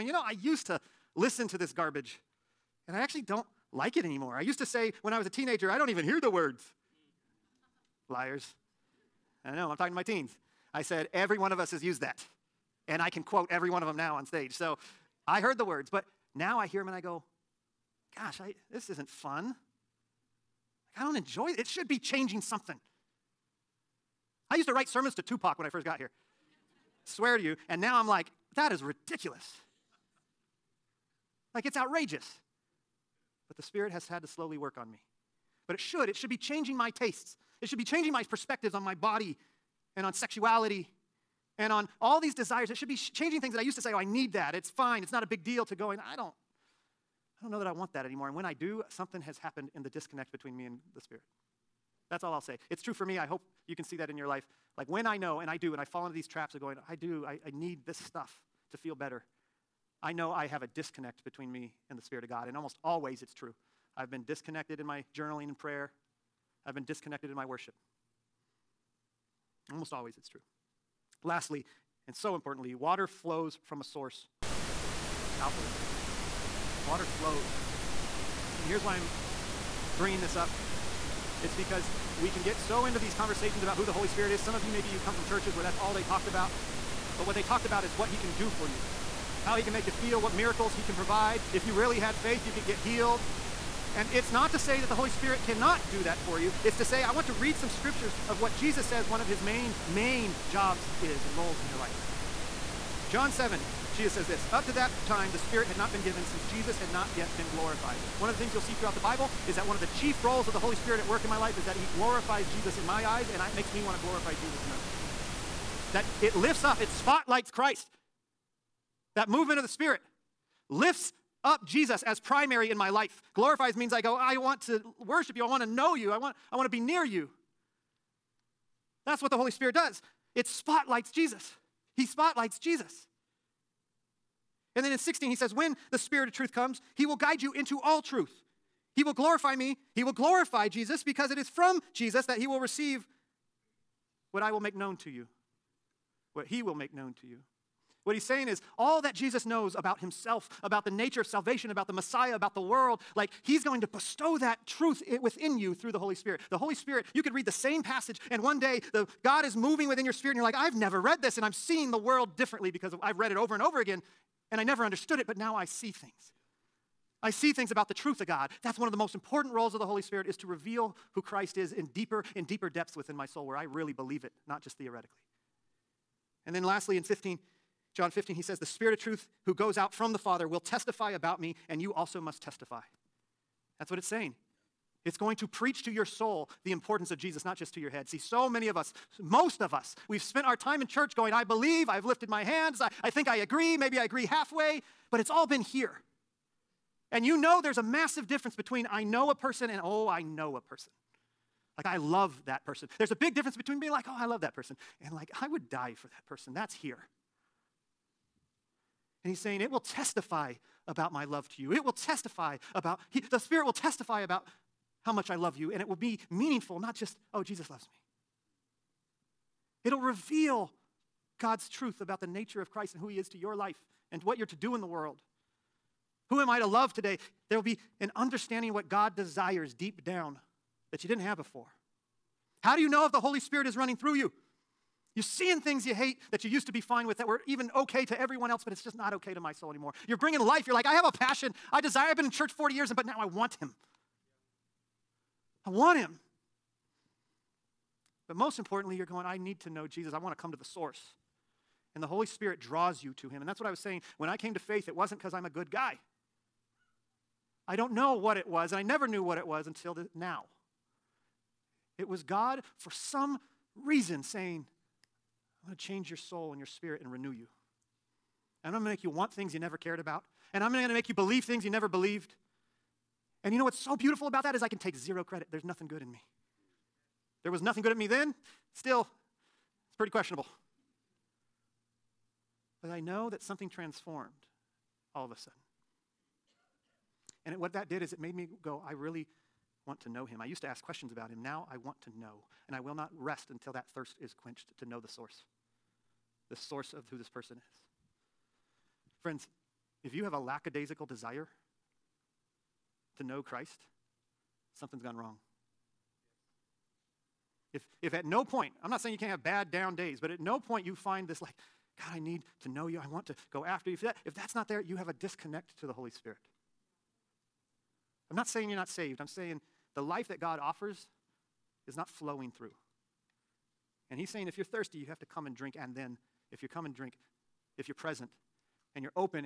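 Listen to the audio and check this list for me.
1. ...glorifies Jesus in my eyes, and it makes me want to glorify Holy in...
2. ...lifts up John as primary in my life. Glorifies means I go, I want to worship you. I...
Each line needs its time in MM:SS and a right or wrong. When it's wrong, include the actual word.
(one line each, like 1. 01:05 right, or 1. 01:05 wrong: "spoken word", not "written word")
1. 01:51 wrong: "Jesus", not "Holy"
2. 02:00 wrong: "Jesus", not "John".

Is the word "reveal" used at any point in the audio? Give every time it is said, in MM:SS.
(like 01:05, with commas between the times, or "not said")
02:50, 03:39.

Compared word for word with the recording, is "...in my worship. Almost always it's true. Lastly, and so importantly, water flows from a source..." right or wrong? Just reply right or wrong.
right.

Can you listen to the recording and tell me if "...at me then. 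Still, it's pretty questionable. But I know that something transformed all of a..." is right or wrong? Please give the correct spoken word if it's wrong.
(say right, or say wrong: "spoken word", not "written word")
right.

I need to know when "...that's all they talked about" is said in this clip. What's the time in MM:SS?
01:25.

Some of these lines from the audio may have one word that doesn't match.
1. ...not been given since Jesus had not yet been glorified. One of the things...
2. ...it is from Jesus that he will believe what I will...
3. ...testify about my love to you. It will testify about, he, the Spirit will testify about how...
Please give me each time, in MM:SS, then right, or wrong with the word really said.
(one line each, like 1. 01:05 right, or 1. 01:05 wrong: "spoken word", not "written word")
1. 01:45 right
2. 02:21 wrong: "receive", not "believe"
3. 03:29 right.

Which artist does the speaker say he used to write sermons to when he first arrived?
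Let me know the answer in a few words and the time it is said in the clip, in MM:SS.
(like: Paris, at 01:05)
Tupac, at 00:25.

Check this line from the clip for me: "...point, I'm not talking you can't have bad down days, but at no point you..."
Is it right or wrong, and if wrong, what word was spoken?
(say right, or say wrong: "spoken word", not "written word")
wrong: "saying", not "talking".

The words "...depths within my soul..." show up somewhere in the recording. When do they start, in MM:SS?
02:52.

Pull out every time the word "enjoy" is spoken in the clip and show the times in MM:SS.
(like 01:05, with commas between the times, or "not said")
00:21.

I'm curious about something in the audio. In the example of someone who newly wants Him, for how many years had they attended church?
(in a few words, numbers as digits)
40.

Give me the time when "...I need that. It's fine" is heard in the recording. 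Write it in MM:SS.
00:43.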